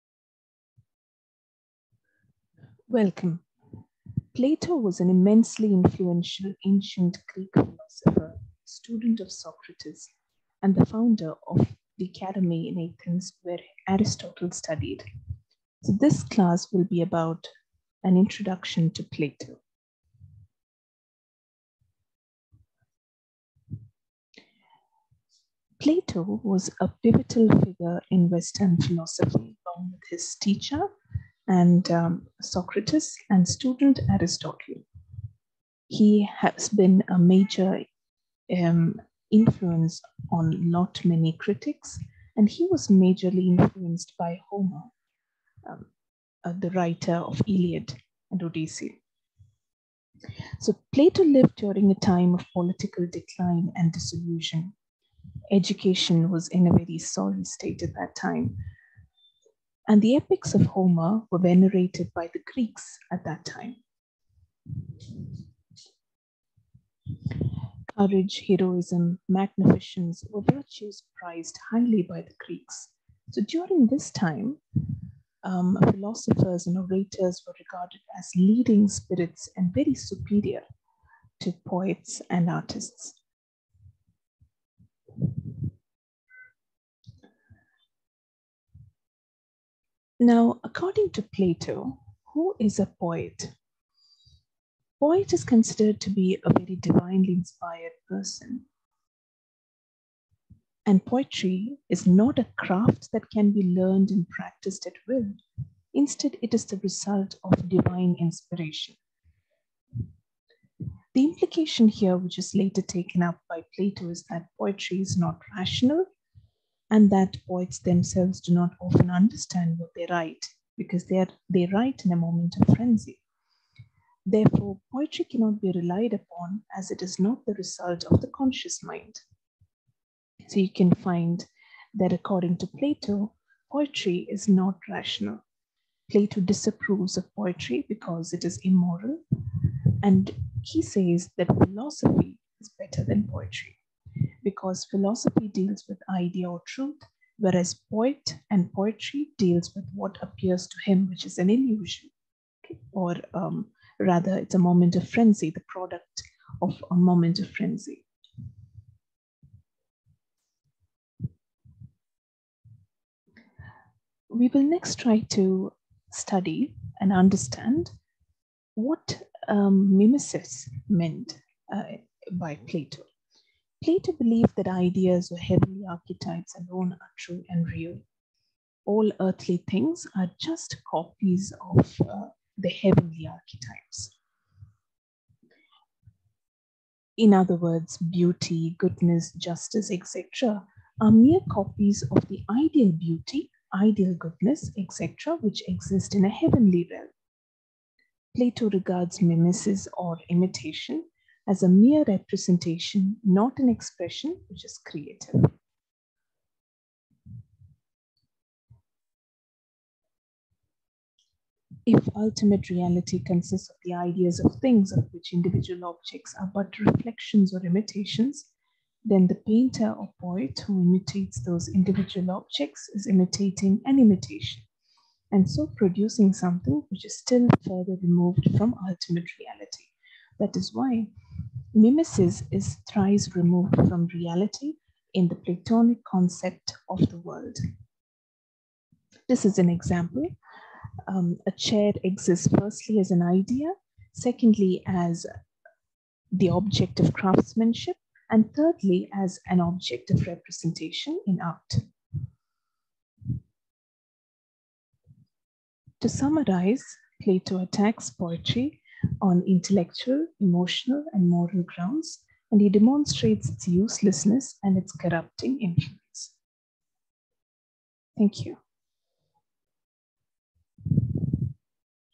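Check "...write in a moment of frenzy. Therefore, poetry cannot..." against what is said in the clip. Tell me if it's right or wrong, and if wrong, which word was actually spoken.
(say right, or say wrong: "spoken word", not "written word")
right.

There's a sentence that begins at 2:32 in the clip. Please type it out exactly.
or um, rather, it's a moment of frenzy, the product of a moment of frenzy.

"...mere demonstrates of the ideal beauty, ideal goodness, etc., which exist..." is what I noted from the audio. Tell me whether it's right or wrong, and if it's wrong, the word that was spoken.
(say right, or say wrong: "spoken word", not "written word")
wrong: "copies", not "demonstrates".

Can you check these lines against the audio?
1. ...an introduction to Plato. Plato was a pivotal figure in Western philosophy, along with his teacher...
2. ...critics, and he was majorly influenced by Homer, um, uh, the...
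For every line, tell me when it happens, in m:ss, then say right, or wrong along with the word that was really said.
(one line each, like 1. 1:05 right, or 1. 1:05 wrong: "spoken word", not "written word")
1. 0:18 right
2. 0:41 right.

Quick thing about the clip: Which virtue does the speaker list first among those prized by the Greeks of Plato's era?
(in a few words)
Courage.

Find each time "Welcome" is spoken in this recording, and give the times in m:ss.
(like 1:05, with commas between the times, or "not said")
0:02.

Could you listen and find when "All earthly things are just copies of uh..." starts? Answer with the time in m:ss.
2:58.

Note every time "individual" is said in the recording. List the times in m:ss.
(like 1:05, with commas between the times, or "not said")
3:35, 3:41.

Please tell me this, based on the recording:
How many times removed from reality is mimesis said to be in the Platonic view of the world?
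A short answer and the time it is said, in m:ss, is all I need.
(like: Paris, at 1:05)
Thrice, at 3:52.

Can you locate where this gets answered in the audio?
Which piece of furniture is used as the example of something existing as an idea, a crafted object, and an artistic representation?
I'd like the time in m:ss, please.
4:01.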